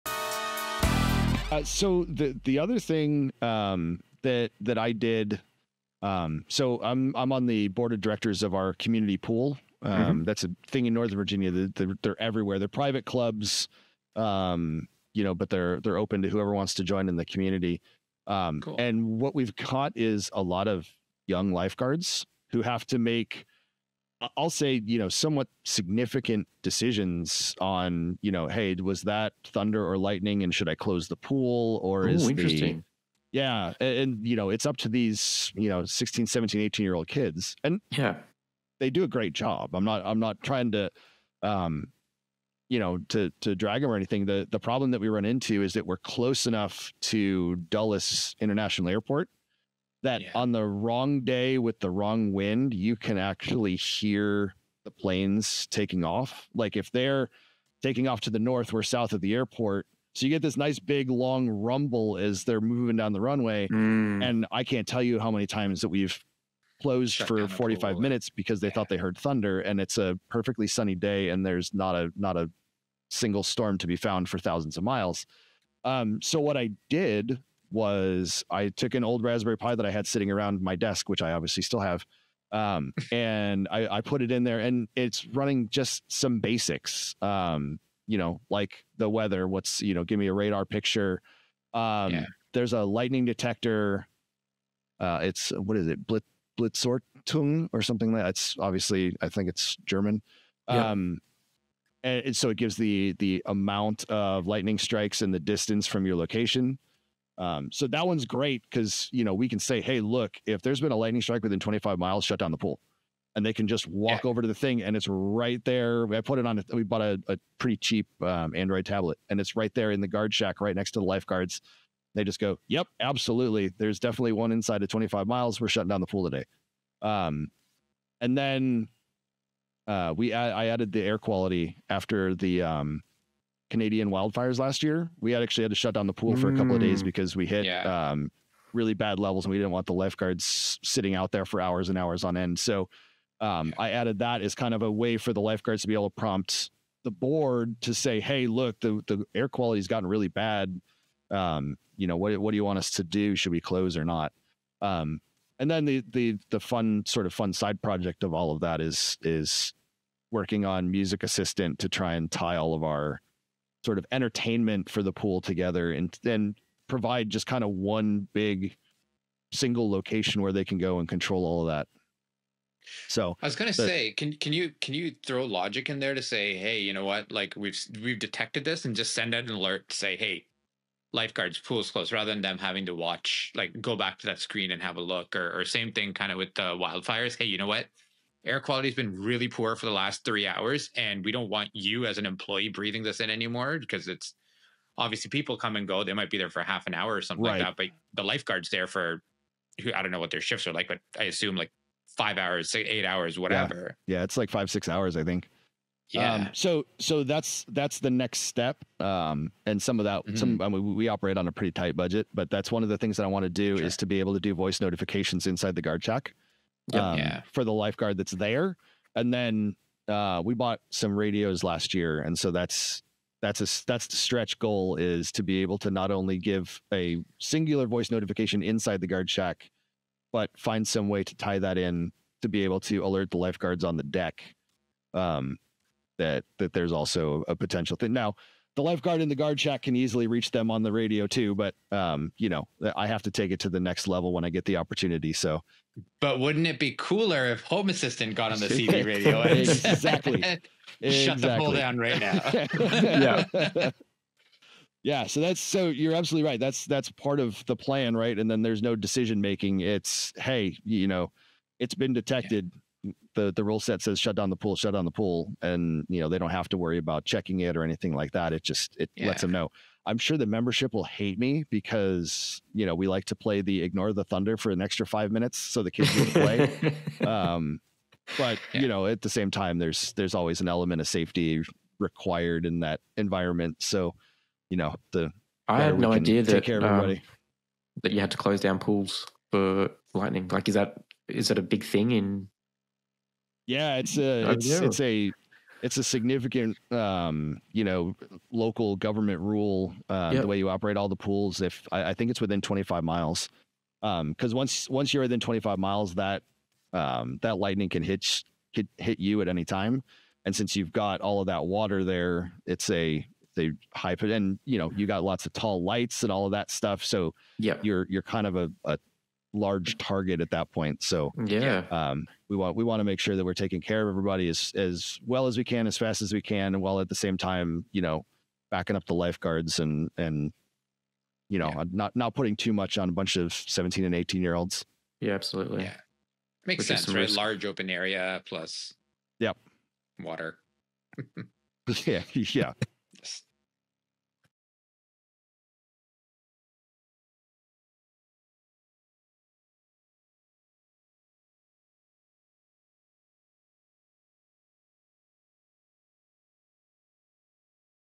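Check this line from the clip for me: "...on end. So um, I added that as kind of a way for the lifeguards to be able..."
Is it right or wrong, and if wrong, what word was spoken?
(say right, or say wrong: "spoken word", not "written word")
right.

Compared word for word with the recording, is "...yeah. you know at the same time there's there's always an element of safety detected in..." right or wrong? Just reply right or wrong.
wrong.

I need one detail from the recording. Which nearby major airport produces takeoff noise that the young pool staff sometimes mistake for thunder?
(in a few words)
Dulles International Airport.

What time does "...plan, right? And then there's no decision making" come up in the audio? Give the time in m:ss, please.
4:17.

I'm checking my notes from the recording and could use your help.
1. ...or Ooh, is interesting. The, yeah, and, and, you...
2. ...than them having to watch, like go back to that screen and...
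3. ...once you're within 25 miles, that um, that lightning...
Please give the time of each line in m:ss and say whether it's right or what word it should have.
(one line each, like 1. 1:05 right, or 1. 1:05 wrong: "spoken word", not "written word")
1. 0:31 right
2. 3:02 right
3. 5:04 right.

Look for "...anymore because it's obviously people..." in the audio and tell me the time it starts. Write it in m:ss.
3:13.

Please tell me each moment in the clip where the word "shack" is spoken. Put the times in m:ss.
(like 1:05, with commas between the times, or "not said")
2:00, 3:36, 3:49, 3:59.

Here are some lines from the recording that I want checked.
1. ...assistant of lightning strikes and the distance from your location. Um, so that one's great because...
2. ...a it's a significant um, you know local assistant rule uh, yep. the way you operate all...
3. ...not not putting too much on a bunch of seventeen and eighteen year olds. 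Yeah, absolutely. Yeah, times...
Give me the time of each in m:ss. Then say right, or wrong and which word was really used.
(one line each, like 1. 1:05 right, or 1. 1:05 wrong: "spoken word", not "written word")
1. 1:43 wrong: "amount", not "assistant"
2. 4:54 wrong: "government", not "assistant"
3. 5:31 wrong: "makes", not "times".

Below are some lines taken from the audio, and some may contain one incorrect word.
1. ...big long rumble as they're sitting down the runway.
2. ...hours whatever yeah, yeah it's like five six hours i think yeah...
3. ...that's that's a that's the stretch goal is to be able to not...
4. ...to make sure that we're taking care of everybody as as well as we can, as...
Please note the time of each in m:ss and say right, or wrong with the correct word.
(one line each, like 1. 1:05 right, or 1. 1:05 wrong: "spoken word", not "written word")
1. 1:00 wrong: "moving", not "sitting"
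2. 3:23 right
3. 3:42 right
4. 5:22 right.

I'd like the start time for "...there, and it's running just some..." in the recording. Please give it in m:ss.
1:24.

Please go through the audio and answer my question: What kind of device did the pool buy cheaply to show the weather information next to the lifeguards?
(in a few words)
Android tablet.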